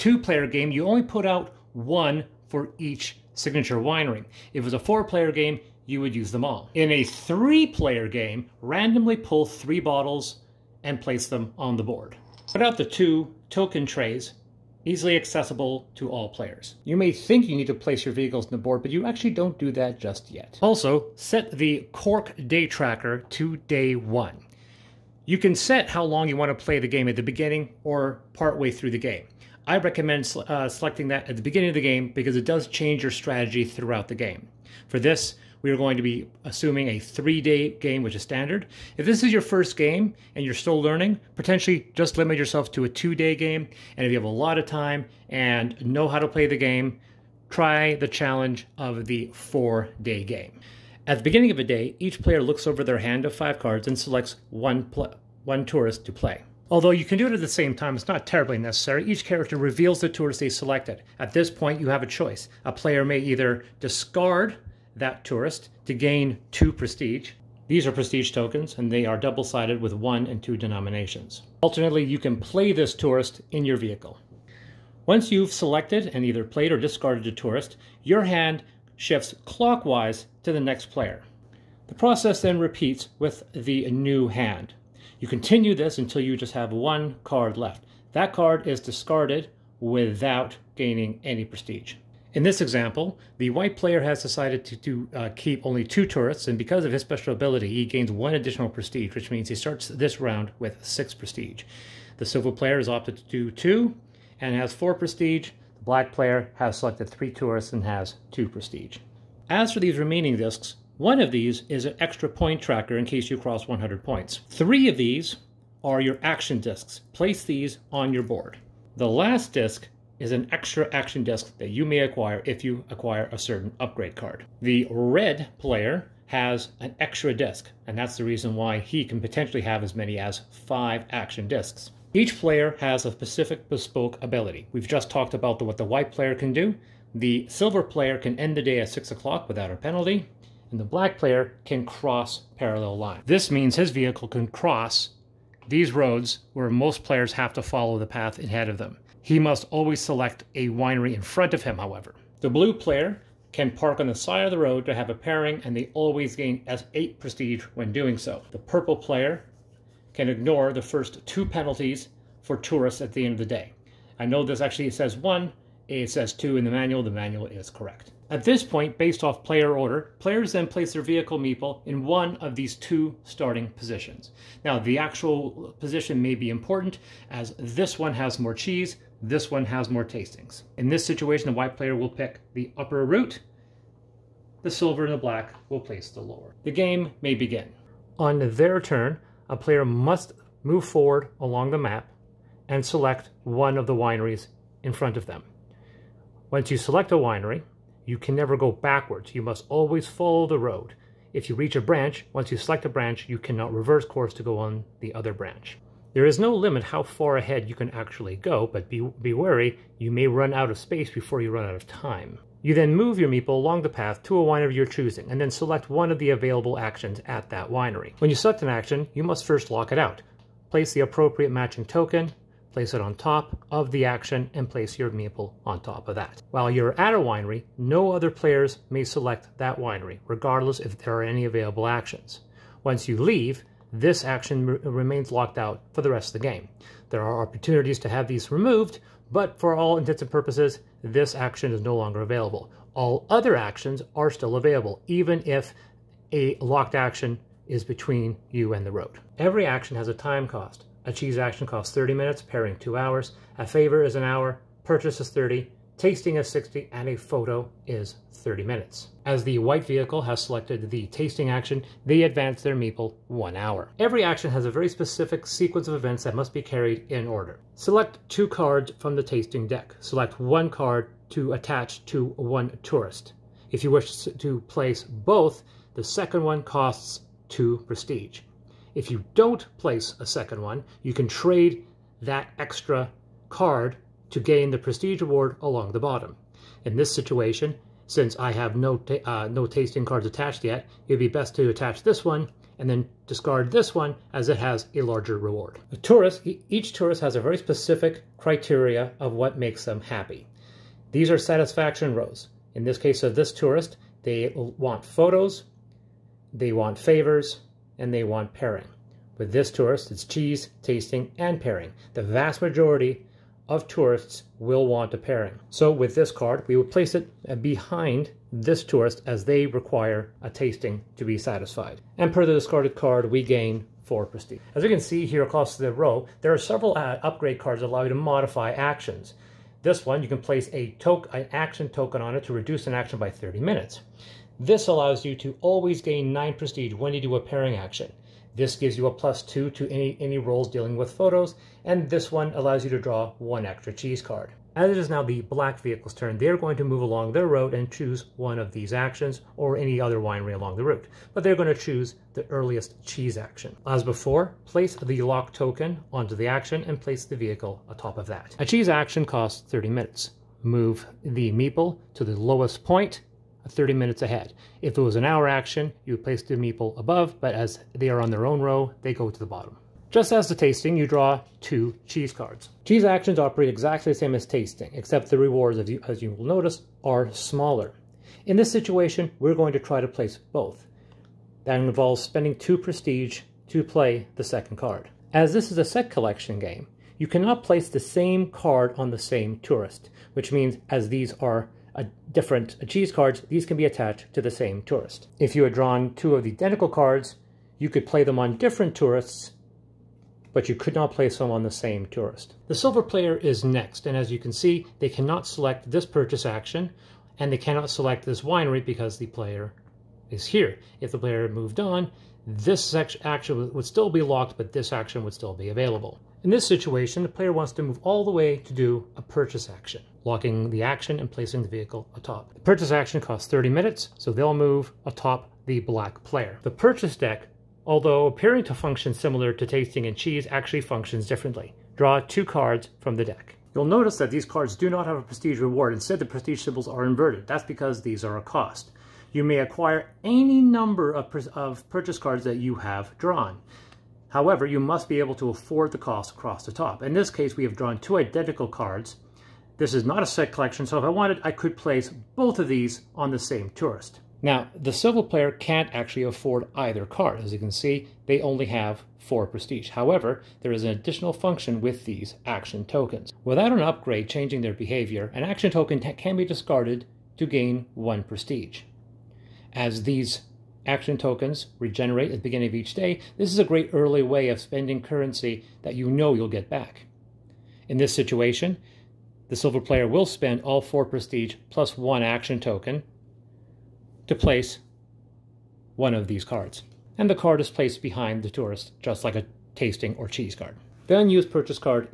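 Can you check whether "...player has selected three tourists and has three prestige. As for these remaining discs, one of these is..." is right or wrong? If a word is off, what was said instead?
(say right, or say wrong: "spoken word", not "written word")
wrong: "two", not "three".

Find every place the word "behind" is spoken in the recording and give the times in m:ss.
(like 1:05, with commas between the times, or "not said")
5:17, 8:08.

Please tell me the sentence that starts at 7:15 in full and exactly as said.
Instead, the prestige symbols are inverted.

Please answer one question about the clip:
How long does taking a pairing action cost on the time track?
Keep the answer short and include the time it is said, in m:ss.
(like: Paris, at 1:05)
2 hours, at 4:12.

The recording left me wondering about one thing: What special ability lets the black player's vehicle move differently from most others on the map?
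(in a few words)
Cross parallel lines.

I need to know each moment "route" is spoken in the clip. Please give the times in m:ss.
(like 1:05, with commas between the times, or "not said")
3:03, 5:50.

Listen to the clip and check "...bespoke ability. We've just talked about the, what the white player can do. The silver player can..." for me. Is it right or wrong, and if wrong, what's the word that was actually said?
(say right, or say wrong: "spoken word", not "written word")
right.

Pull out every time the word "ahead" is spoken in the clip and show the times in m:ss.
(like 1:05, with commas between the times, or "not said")
2:28, 3:27, 6:04.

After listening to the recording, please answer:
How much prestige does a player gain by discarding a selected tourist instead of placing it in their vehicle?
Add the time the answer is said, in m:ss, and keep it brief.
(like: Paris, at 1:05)
2, at 1:05.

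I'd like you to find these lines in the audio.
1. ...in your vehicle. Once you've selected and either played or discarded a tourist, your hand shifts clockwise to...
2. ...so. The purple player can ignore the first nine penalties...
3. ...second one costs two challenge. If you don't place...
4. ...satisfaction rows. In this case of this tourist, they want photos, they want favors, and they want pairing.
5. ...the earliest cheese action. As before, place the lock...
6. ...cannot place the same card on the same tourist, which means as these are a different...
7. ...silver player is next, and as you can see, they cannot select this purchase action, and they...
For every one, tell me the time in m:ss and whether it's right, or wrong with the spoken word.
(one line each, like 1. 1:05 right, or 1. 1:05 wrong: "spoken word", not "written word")
1. 1:13 right
2. 2:38 wrong: "two", not "nine"
3. 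4:36 wrong: "prestige", not "challenge"
4. 5:01 right
5. 5:52 right
6. 6:27 right
7. 6:42 right.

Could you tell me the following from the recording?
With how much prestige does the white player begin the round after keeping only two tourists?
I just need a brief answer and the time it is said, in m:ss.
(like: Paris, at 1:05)
6, at 1:40.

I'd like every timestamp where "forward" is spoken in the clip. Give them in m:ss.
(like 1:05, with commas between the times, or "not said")
3:10.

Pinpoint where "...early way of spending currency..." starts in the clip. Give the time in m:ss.
7:53.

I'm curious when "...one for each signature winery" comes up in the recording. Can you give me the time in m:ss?
0:01.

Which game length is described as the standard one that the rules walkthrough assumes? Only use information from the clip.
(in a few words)
Three-day game.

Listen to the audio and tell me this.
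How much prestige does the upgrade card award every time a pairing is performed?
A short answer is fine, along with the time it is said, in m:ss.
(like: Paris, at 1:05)
9, at 5:36.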